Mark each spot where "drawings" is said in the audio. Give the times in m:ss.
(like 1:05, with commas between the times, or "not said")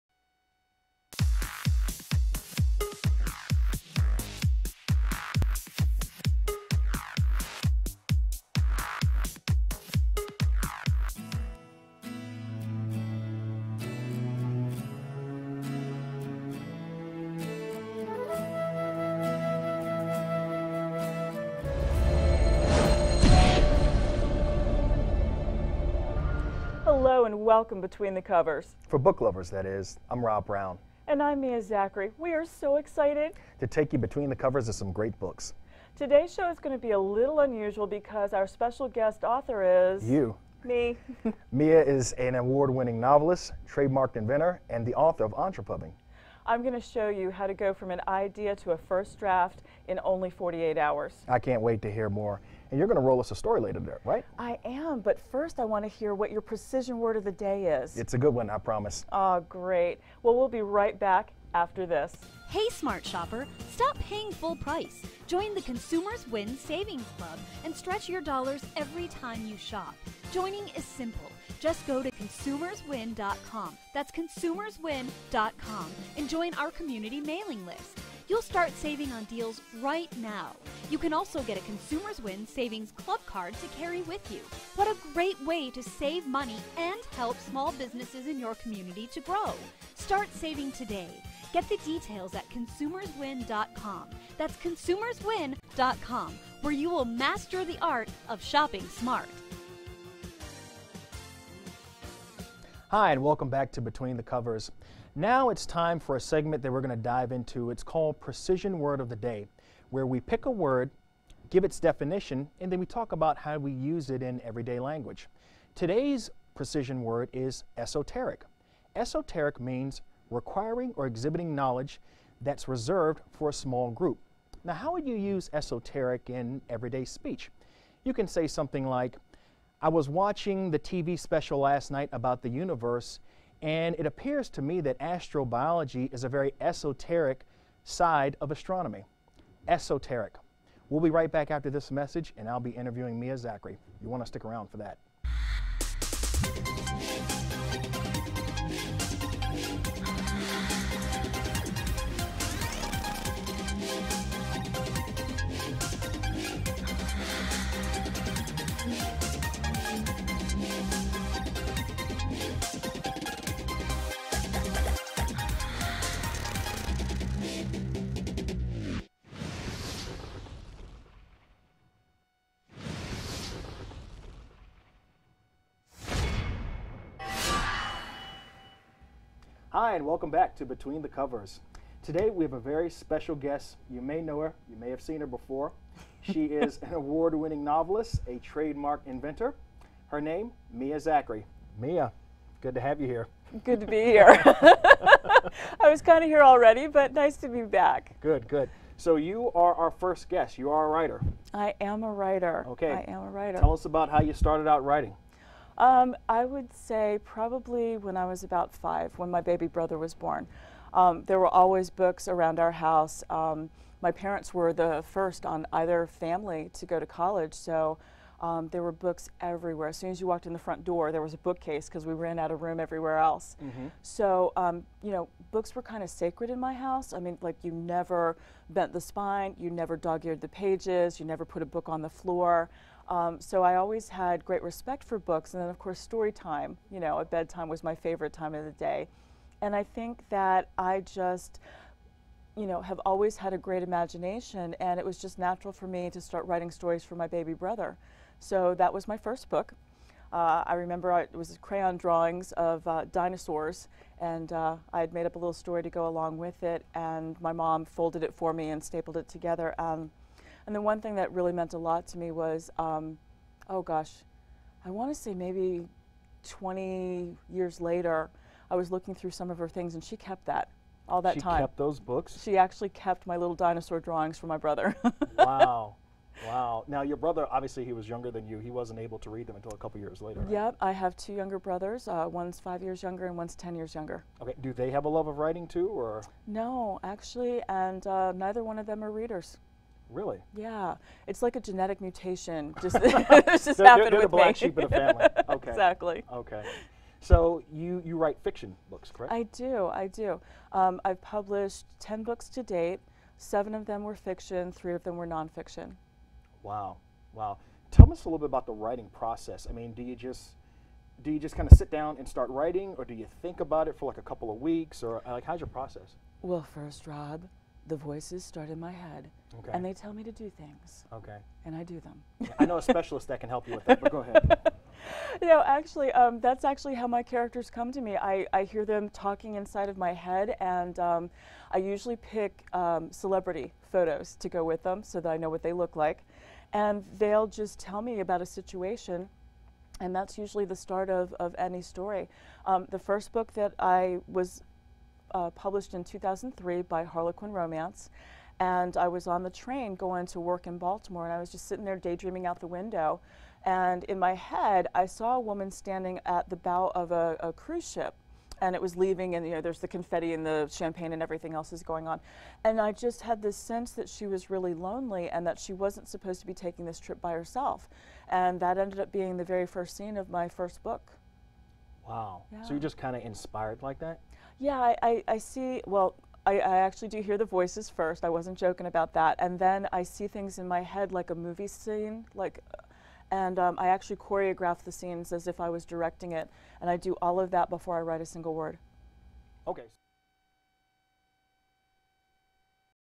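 4:11, 4:33.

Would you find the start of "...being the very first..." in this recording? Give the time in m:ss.
6:09.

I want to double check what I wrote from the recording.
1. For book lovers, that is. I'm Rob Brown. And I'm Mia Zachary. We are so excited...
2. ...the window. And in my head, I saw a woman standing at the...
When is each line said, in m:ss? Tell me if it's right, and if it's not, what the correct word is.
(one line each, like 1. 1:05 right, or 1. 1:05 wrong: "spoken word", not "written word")
1. 0:28 right
2. 5:52 right.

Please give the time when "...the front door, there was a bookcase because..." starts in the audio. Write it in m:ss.
3:40.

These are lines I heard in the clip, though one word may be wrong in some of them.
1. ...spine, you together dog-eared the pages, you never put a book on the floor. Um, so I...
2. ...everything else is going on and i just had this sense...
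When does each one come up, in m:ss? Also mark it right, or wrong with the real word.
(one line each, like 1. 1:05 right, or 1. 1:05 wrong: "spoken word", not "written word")
1. 3:49 wrong: "never", not "together"
2. 6:01 right.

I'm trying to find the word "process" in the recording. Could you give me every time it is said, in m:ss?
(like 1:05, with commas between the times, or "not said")
5:09, 5:15.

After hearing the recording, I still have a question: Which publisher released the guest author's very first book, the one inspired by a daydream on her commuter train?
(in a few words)
Harlequin Romance.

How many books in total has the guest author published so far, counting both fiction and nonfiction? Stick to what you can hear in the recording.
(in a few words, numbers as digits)
10.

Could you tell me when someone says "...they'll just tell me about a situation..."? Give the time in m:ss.
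5:37.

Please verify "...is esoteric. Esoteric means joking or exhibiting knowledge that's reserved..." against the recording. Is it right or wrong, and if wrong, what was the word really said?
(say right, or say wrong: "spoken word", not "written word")
wrong: "requiring", not "joking".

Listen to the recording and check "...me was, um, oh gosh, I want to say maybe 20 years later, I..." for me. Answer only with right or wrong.
right.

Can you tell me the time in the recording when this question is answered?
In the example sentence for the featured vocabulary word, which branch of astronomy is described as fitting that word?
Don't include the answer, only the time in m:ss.
2:14.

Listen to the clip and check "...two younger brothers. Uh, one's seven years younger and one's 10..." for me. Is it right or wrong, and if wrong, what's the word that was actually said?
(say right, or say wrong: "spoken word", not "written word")
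wrong: "five", not "seven".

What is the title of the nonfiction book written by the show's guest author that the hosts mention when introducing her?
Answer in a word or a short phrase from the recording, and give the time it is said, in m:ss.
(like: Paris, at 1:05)
Entrepubbing, at 0:45.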